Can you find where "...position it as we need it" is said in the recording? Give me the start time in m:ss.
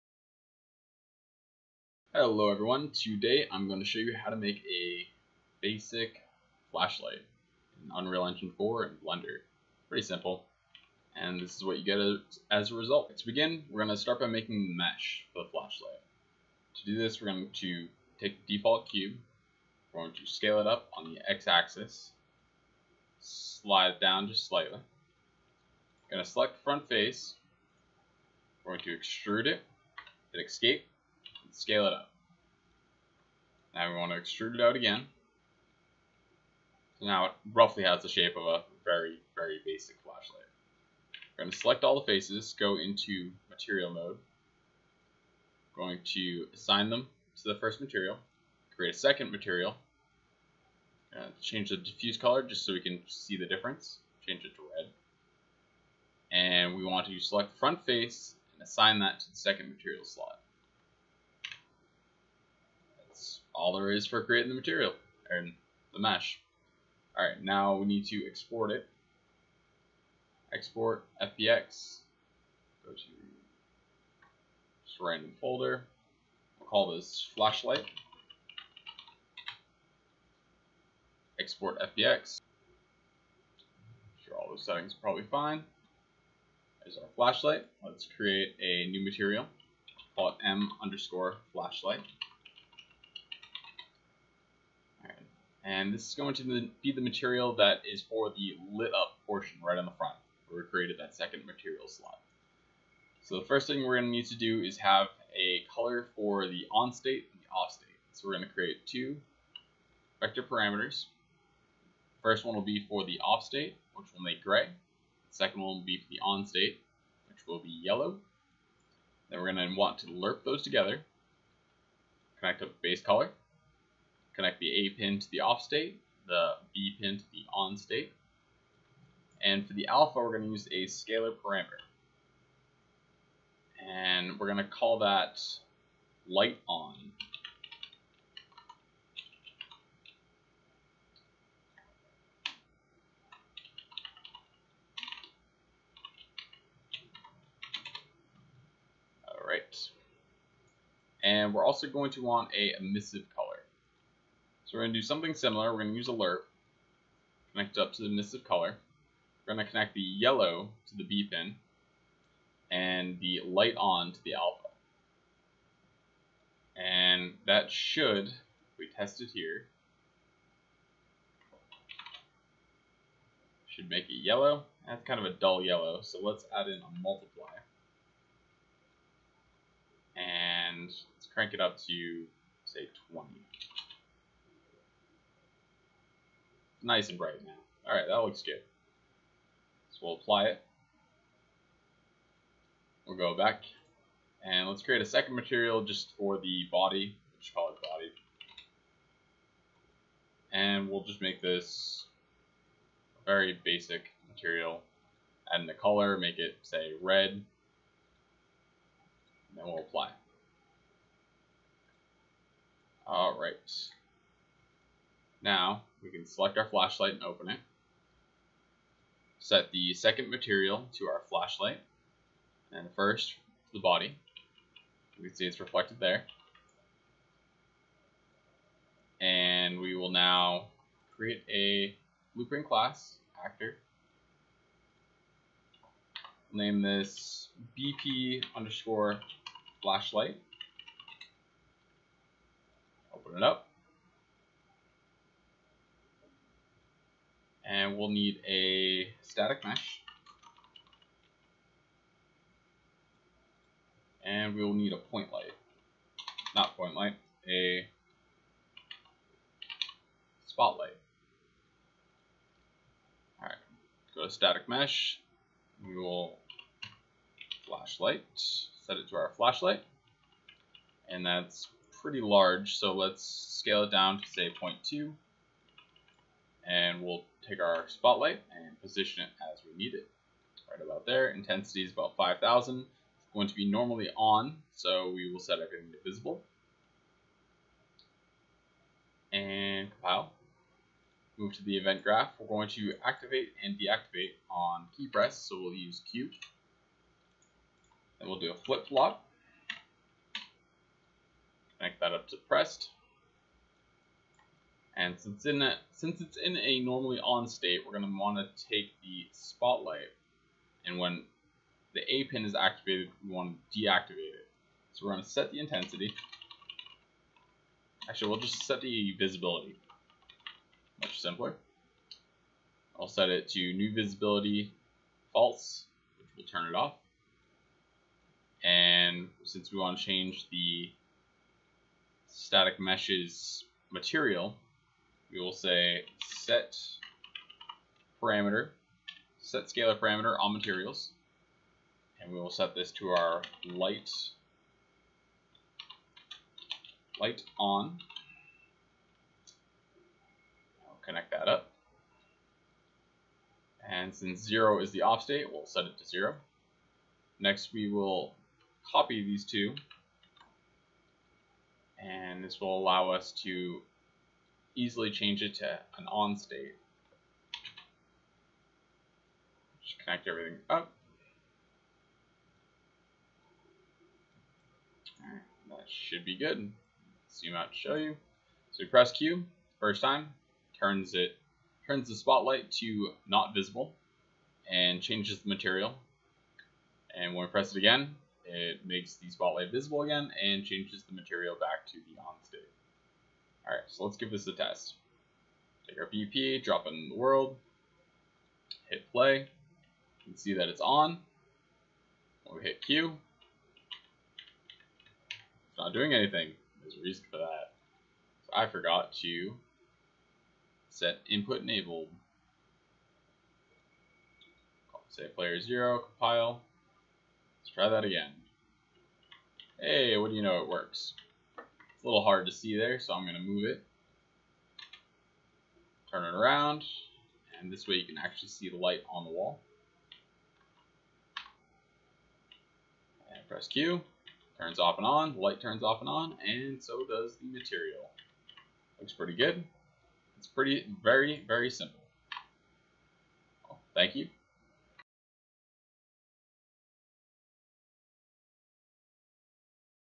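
4:38.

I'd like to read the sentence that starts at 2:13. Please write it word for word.
And we're going to call that light on.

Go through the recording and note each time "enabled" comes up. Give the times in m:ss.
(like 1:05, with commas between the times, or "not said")
6:51.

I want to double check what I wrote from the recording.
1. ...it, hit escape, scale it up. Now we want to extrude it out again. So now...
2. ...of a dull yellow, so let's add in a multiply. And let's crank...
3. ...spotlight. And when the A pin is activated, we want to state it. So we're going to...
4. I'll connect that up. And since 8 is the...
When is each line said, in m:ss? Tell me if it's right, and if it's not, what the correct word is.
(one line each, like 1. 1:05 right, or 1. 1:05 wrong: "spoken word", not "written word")
1. 0:29 right
2. 2:55 right
3. 5:09 wrong: "deactivate", not "state"
4. 5:50 wrong: "0", not "8".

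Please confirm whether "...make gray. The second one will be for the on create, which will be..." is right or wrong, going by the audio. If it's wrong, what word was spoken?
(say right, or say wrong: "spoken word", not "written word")
wrong: "state", not "create".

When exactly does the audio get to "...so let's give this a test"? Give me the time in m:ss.
6:33.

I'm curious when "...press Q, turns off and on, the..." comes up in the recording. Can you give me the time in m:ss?
7:13.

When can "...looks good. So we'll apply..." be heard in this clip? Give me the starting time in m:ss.
3:08.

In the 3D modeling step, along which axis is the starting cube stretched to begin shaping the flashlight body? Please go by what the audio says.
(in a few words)
x-axis.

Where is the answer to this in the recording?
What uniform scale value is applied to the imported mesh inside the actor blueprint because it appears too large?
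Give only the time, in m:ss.
4:34.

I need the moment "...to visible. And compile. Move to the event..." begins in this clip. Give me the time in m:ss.
4:45.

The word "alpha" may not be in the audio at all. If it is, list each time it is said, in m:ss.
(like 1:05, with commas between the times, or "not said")
2:09, 2:44.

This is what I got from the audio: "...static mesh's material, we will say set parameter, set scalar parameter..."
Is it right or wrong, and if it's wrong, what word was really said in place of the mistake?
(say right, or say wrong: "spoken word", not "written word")
right.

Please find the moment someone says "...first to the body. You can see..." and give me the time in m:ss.
3:42.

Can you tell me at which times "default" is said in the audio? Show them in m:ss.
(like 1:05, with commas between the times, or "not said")
0:18.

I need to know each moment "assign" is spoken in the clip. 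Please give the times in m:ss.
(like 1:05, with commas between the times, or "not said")
0:46, 0:58.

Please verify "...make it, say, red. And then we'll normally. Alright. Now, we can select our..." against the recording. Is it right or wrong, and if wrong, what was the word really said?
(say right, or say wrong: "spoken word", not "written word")
wrong: "apply", not "normally".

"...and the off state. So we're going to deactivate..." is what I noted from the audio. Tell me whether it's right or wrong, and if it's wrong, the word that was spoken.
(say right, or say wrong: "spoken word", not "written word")
wrong: "create", not "deactivate".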